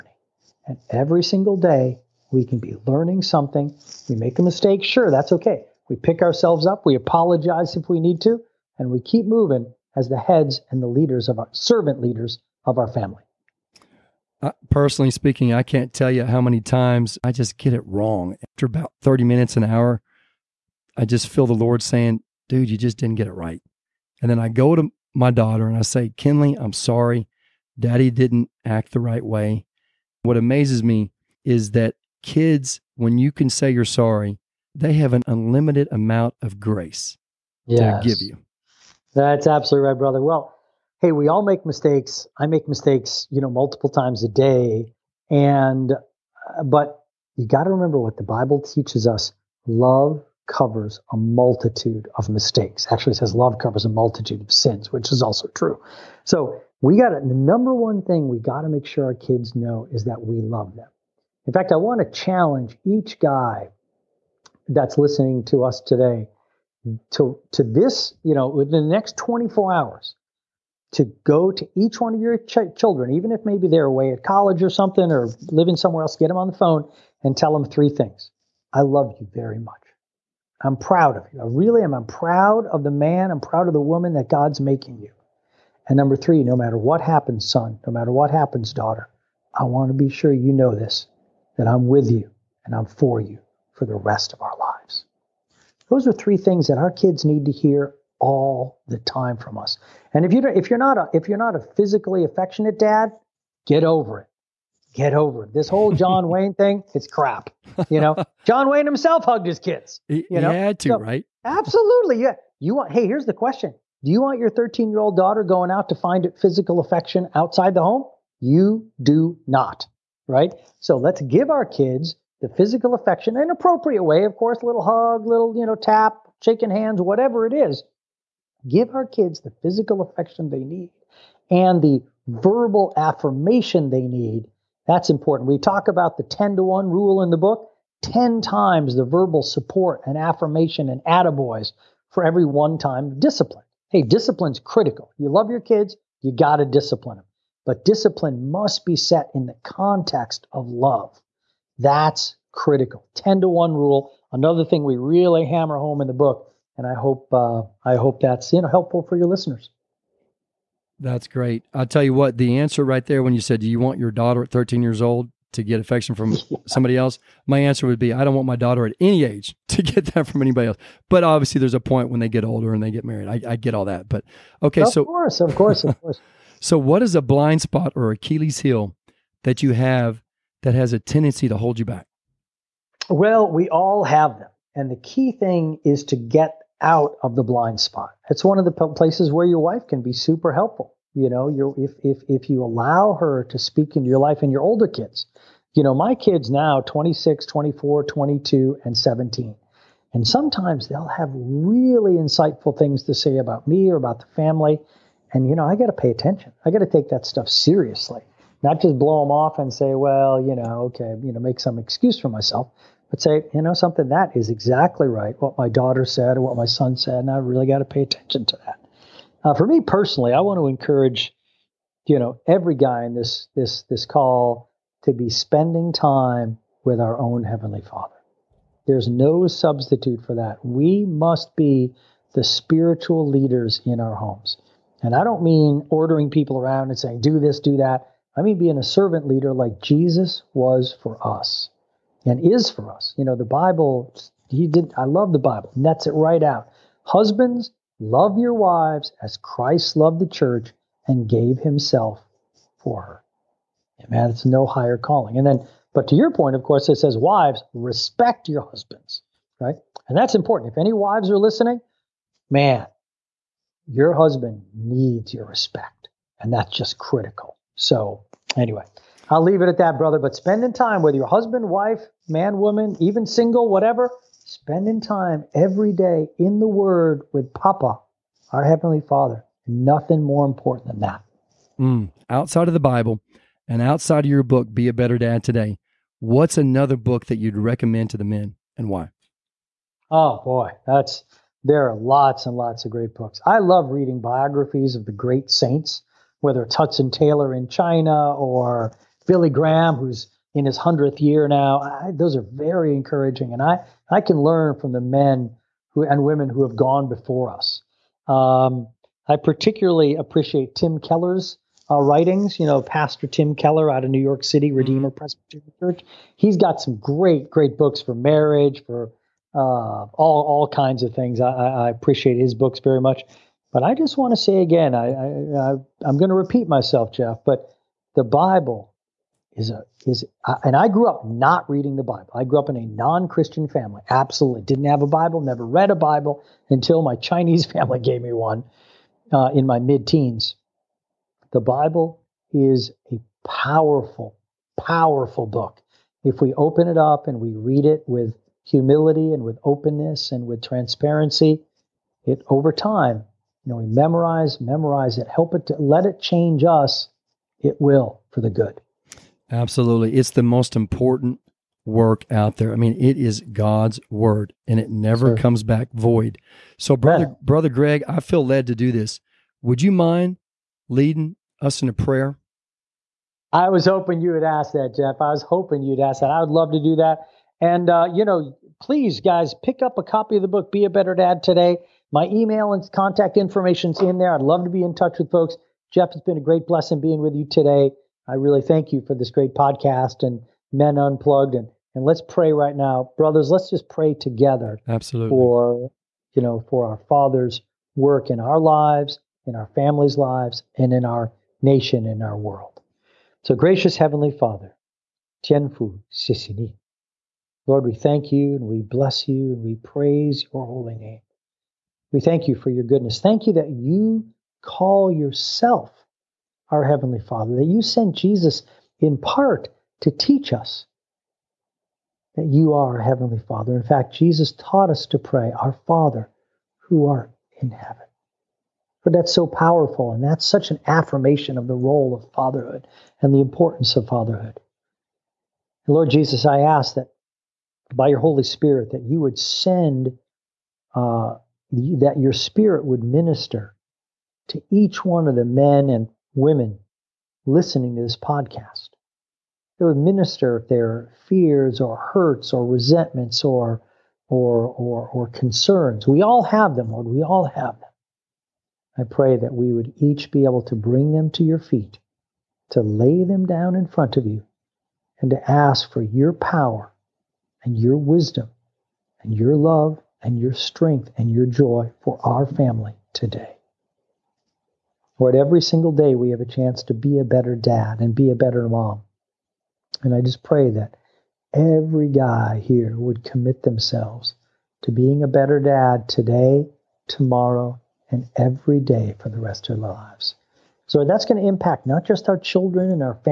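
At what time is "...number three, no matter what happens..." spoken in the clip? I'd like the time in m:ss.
1:25.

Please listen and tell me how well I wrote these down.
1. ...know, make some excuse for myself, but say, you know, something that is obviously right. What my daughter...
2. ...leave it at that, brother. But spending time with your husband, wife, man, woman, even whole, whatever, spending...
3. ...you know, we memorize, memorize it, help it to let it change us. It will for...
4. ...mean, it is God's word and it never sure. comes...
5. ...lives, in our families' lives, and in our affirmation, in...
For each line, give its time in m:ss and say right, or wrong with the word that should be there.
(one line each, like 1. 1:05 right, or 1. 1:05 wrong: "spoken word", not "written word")
1. 3:31 wrong: "exactly", not "obviously"
2. 4:29 wrong: "single", not "whole"
3. 5:53 right
4. 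6:02 right
5. 6:38 wrong: "nation", not "affirmation".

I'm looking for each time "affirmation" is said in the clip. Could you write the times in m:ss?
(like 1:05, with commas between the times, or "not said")
2:12, 2:20, 7:10.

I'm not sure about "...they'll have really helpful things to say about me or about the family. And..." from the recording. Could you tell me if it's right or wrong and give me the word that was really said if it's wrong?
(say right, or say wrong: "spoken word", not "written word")
wrong: "insightful", not "helpful".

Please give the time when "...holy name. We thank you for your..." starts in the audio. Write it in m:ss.
6:50.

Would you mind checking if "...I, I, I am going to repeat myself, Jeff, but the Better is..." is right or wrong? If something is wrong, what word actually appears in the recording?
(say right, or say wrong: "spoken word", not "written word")
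wrong: "Bible", not "Better".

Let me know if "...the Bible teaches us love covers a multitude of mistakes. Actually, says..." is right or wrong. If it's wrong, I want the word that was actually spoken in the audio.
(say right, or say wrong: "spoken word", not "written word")
right.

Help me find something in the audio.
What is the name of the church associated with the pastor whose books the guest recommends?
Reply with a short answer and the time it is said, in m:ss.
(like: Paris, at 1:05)
Redeemer Presbyterian Church, at 5:14.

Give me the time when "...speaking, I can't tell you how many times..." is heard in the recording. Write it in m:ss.
0:15.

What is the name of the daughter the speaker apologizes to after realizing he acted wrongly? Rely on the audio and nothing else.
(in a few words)
Kinley.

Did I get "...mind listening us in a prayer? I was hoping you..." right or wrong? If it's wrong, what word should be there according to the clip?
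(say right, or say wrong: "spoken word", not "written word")
wrong: "leading", not "listening".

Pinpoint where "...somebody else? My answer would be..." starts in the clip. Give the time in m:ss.
2:46.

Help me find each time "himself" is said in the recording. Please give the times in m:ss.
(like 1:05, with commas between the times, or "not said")
1:48, 4:11.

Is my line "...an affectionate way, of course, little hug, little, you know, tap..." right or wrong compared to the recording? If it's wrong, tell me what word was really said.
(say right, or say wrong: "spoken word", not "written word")
wrong: "appropriate", not "affectionate".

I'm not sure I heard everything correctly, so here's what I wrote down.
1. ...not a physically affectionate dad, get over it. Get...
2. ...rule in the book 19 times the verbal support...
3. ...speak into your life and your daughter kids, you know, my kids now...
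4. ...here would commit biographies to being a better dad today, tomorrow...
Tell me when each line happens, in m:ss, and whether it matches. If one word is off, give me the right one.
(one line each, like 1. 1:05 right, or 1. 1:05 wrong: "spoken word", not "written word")
1. 1:41 right
2. 2:16 wrong: "10", not "19"
3. 3:13 wrong: "older", not "daughter"
4. 8:02 wrong: "themselves", not "biographies".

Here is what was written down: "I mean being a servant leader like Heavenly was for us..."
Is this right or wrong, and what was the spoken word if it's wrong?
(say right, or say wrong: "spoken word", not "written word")
wrong: "Jesus", not "Heavenly".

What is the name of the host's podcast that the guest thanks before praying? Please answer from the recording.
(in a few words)
Men Unplugged.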